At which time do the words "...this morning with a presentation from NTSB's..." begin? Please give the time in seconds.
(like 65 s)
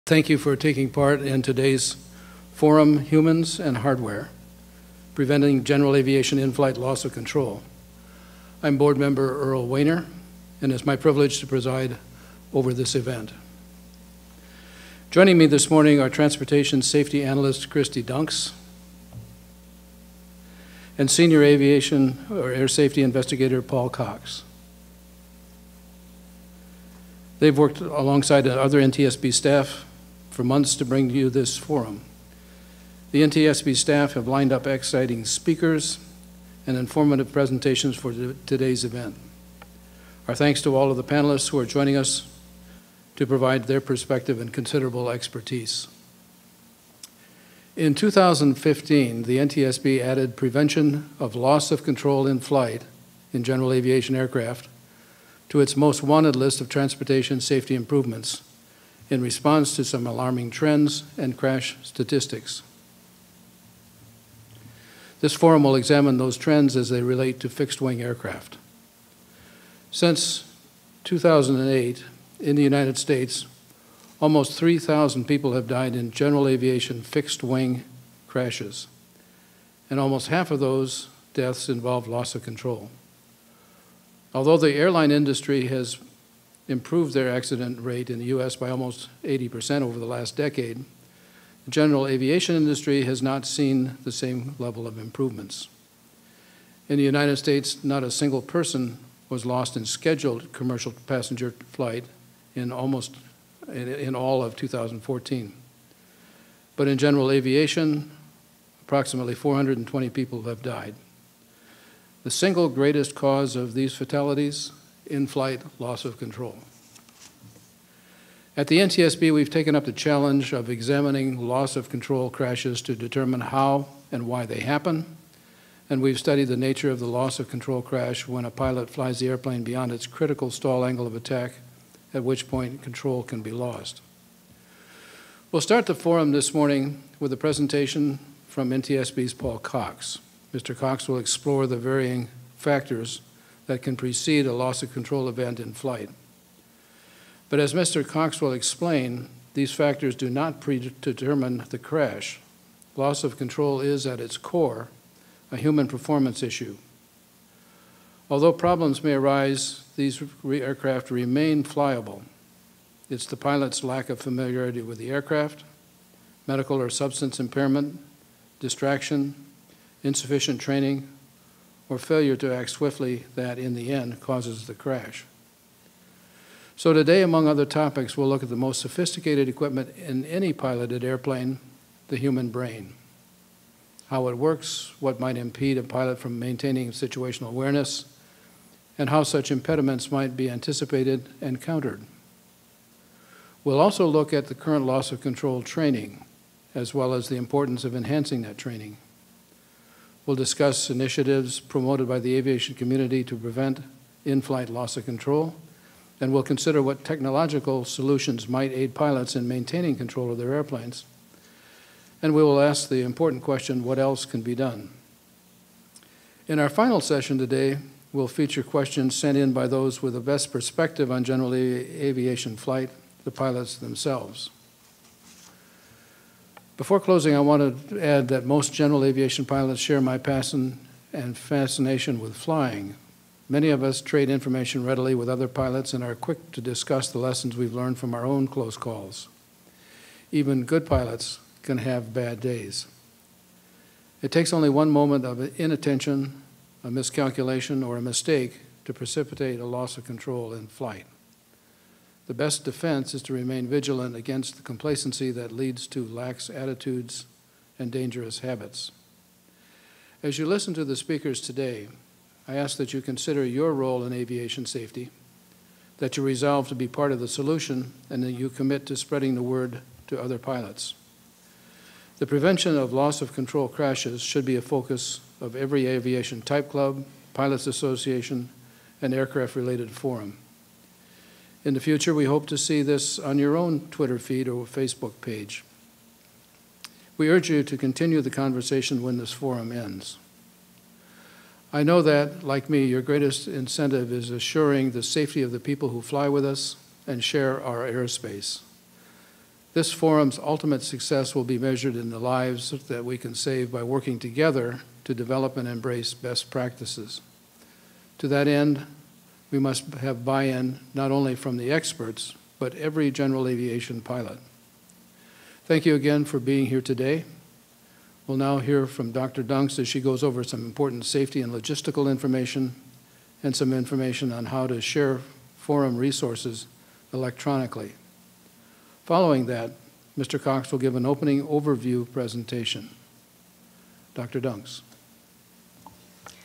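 136 s.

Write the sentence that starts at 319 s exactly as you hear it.
Dunks as she goes over some important safety and logistical information and some information on how to share forum resources electronically.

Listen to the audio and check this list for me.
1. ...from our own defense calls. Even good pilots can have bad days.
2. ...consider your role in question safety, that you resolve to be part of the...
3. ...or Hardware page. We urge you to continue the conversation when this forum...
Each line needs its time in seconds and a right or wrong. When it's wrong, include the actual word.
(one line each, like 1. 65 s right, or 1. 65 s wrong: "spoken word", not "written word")
1. 237 s wrong: "close", not "defense"
2. 263 s wrong: "aviation", not "question"
3. 284 s wrong: "Facebook", not "Hardware".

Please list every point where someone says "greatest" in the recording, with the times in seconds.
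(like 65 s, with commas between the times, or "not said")
112 s, 293 s.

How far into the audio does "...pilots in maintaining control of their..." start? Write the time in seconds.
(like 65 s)
208 s.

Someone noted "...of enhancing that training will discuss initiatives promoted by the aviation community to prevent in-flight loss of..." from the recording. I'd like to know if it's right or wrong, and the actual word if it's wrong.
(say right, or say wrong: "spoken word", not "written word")
right.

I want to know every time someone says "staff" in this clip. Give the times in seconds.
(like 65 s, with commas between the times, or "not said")
29 s, 33 s.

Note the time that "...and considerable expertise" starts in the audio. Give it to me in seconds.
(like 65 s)
44 s.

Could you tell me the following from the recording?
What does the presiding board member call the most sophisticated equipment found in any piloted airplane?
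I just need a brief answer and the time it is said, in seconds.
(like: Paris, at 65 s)
the human brain, at 182 s.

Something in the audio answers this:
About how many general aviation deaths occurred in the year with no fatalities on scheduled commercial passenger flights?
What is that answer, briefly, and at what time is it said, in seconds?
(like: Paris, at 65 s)
420, at 108 s.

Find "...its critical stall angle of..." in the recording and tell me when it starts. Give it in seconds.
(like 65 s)
129 s.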